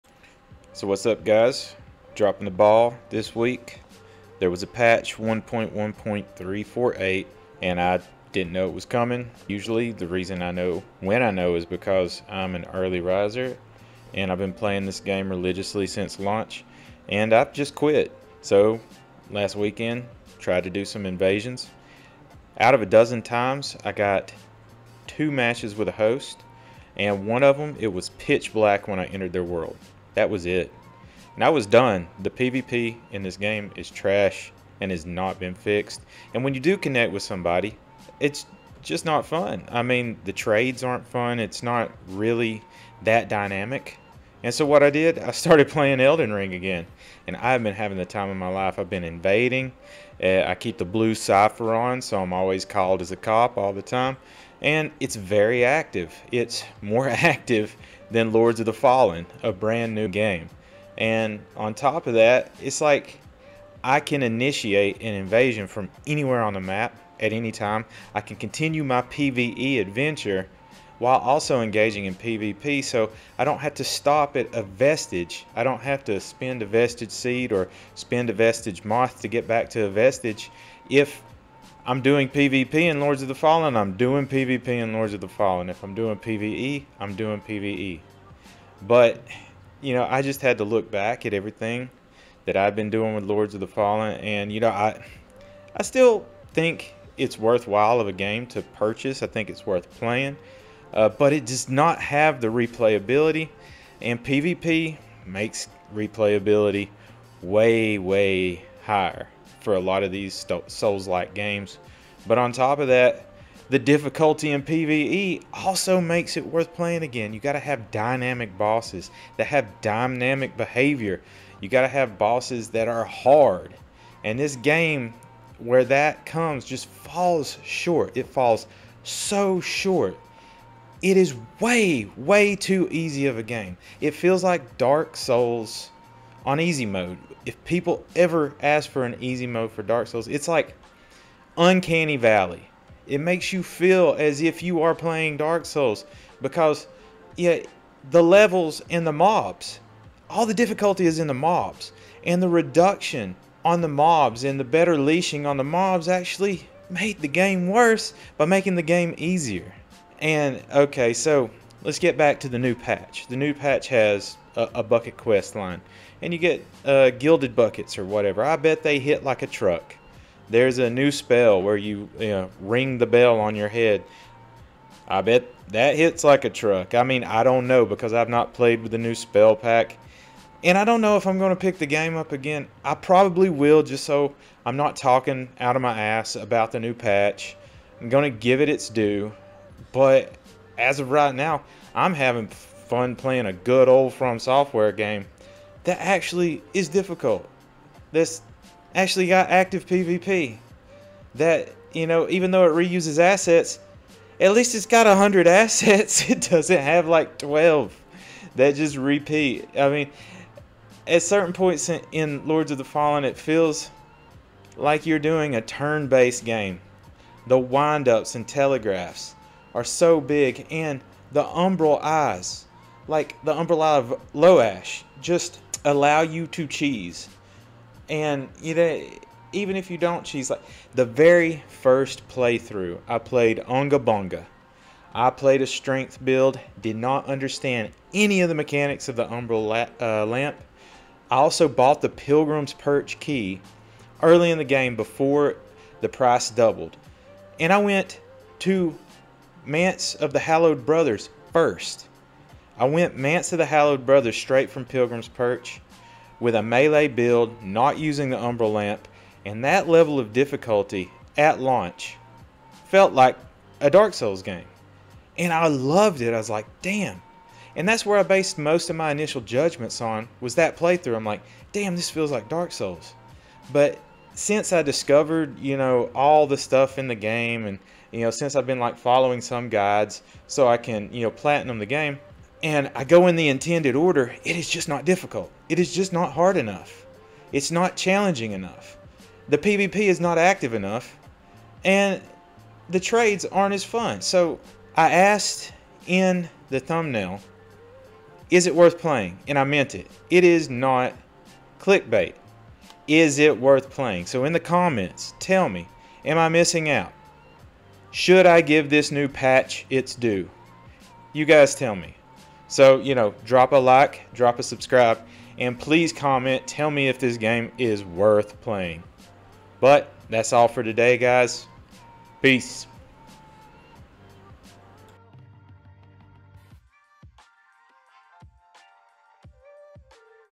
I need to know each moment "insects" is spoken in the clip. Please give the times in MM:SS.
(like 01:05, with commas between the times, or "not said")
not said.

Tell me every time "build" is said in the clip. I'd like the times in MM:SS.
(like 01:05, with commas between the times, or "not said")
03:56, 04:17.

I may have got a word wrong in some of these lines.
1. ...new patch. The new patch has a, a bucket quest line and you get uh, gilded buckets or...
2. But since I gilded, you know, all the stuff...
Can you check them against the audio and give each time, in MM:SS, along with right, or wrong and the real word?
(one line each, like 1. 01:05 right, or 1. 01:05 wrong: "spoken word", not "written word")
1. 02:42 right
2. 04:33 wrong: "discovered", not "gilded".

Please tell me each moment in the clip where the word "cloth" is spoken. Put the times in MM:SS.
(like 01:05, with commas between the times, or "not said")
not said.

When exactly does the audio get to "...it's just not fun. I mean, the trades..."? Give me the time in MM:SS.
00:38.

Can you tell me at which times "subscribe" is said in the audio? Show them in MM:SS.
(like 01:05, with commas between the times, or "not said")
05:14.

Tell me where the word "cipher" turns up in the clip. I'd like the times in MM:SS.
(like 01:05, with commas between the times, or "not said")
00:51.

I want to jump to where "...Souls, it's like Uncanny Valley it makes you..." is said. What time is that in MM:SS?
02:20.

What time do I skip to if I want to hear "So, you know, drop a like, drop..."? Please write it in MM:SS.
05:12.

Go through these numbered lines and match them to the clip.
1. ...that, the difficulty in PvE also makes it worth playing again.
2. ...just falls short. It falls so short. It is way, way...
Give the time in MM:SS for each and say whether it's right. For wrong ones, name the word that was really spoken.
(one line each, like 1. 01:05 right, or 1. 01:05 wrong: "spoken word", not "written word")
1. 01:52 right
2. 02:06 right.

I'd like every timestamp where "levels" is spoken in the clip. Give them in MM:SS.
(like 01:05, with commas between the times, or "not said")
02:28, 04:19.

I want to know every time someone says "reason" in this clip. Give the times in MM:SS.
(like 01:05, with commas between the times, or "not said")
00:10.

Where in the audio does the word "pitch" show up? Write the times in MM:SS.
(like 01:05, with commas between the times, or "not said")
00:28.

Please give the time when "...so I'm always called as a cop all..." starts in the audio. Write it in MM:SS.
00:52.